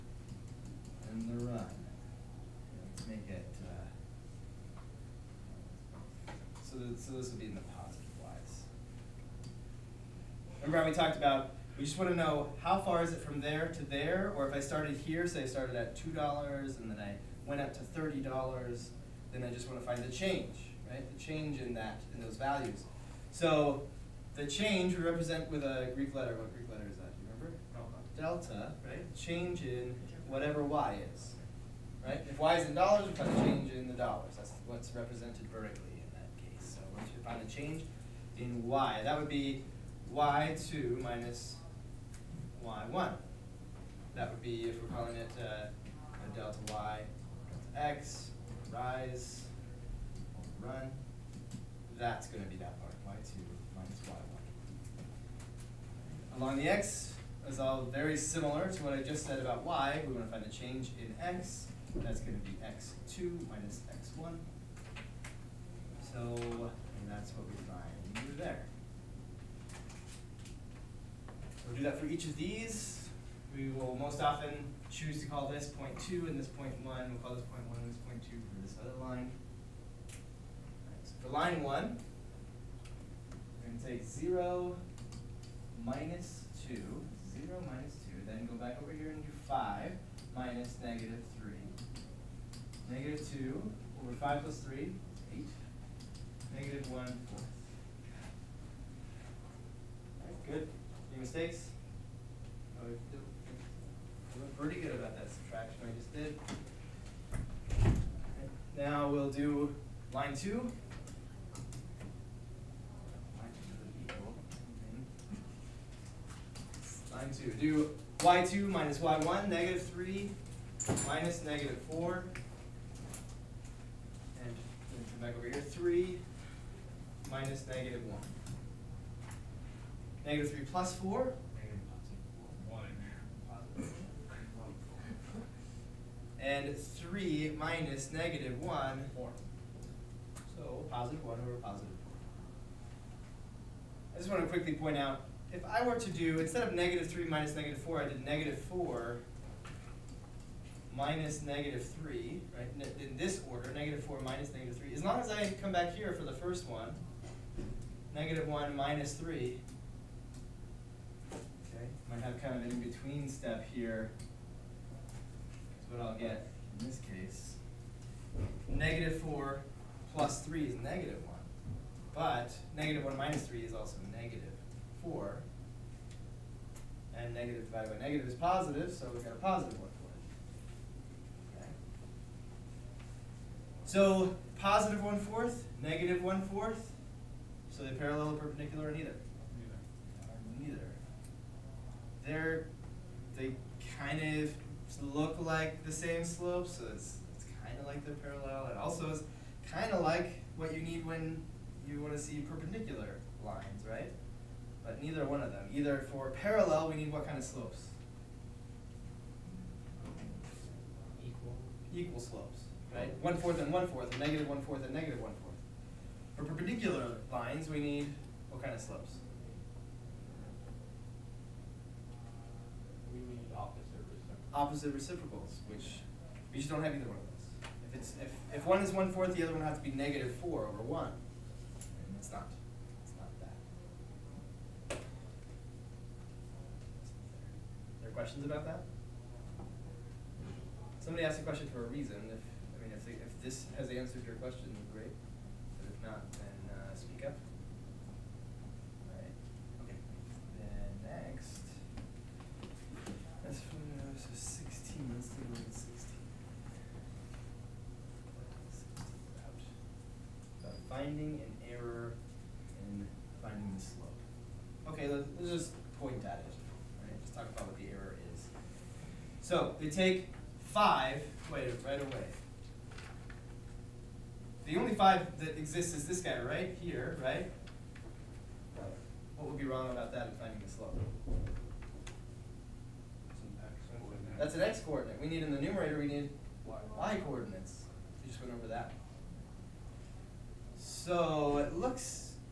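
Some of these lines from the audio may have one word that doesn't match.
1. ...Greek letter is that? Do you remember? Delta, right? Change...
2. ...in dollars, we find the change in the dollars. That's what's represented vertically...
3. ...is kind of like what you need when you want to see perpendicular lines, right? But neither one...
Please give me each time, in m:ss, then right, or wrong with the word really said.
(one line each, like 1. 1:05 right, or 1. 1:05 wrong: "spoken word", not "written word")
1. 0:26 right
2. 0:32 right
3. 3:19 right.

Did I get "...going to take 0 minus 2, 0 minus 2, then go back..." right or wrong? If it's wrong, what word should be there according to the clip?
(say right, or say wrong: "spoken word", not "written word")
right.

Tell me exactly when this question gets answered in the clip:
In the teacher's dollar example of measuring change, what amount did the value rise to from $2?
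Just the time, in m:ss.
0:17.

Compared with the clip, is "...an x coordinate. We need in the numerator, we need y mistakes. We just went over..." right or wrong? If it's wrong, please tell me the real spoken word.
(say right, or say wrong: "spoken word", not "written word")
wrong: "coordinates", not "mistakes".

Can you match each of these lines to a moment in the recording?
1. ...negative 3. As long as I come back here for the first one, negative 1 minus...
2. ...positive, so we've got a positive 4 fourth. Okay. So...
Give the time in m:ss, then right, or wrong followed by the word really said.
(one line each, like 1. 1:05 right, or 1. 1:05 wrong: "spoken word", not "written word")
1. 2:34 right
2. 2:58 wrong: "1", not "4".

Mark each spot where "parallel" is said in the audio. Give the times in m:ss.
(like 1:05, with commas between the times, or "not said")
3:07, 3:18, 3:26.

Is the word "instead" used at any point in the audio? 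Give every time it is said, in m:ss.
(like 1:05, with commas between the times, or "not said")
2:26.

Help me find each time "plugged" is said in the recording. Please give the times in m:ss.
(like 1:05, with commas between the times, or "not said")
not said.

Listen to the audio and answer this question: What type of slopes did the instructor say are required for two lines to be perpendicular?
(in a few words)
Opposite reciprocals.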